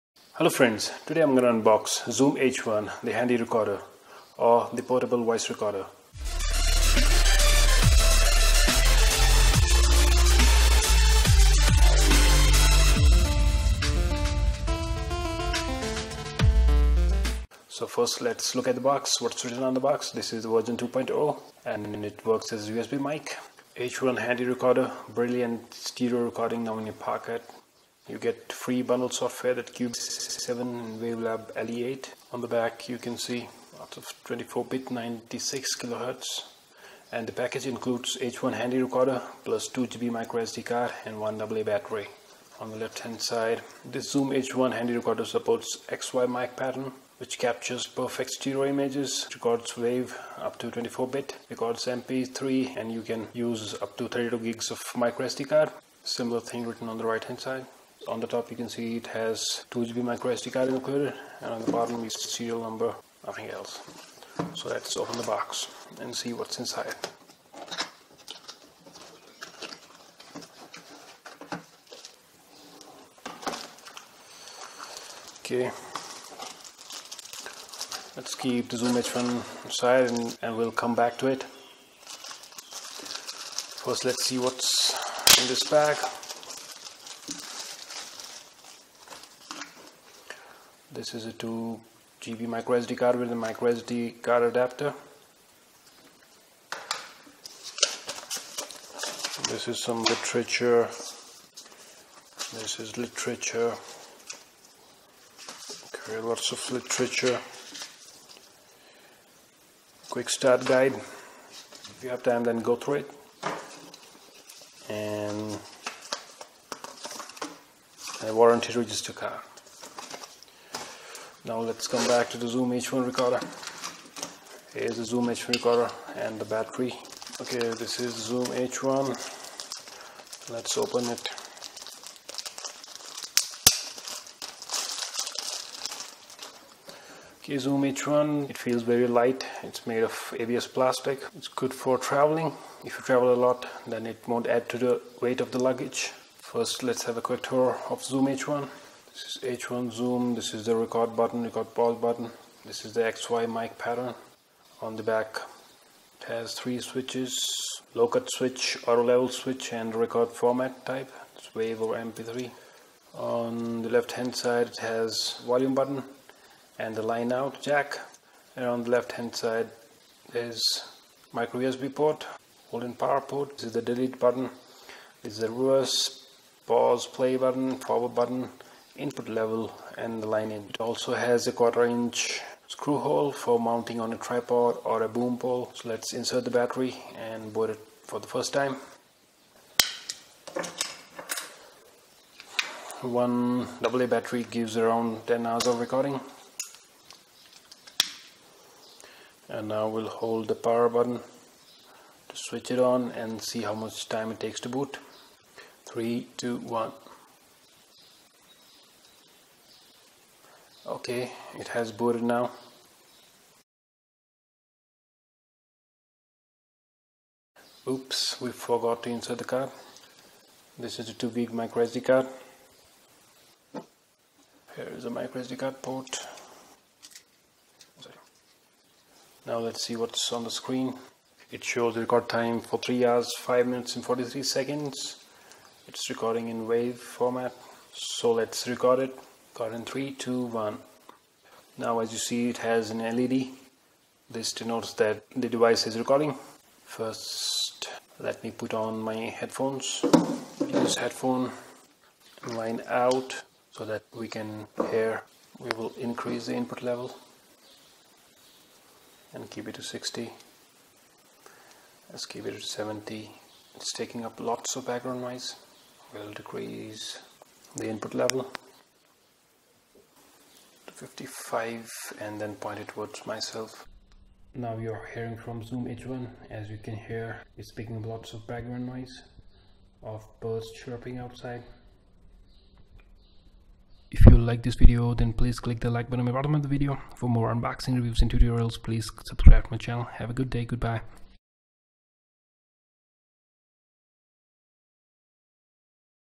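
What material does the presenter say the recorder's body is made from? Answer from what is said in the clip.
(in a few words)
ABS plastic.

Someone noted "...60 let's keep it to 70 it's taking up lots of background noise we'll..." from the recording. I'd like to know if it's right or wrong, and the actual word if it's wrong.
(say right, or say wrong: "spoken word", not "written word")
right.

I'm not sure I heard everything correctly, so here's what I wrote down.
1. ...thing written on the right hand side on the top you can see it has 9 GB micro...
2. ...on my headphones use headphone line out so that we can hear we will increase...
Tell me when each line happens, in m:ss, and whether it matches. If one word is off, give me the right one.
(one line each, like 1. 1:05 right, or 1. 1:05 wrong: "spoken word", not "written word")
1. 0:56 wrong: "2", not "9"
2. 4:08 right.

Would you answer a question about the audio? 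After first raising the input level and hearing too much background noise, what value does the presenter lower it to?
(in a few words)
55.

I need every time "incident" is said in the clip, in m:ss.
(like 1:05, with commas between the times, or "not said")
not said.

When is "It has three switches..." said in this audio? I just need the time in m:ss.
2:36.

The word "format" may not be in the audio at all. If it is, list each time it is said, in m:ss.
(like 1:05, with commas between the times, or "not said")
2:40, 3:56.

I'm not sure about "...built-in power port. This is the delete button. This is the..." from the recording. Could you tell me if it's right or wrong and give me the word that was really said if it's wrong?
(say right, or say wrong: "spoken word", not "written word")
right.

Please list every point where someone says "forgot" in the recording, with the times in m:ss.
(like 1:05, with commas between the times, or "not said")
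3:38.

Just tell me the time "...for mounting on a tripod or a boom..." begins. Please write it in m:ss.
3:03.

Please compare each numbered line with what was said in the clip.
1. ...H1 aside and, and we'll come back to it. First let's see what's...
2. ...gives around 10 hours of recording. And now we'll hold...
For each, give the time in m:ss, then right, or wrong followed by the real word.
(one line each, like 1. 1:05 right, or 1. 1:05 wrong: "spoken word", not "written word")
1. 1:18 right
2. 3:14 right.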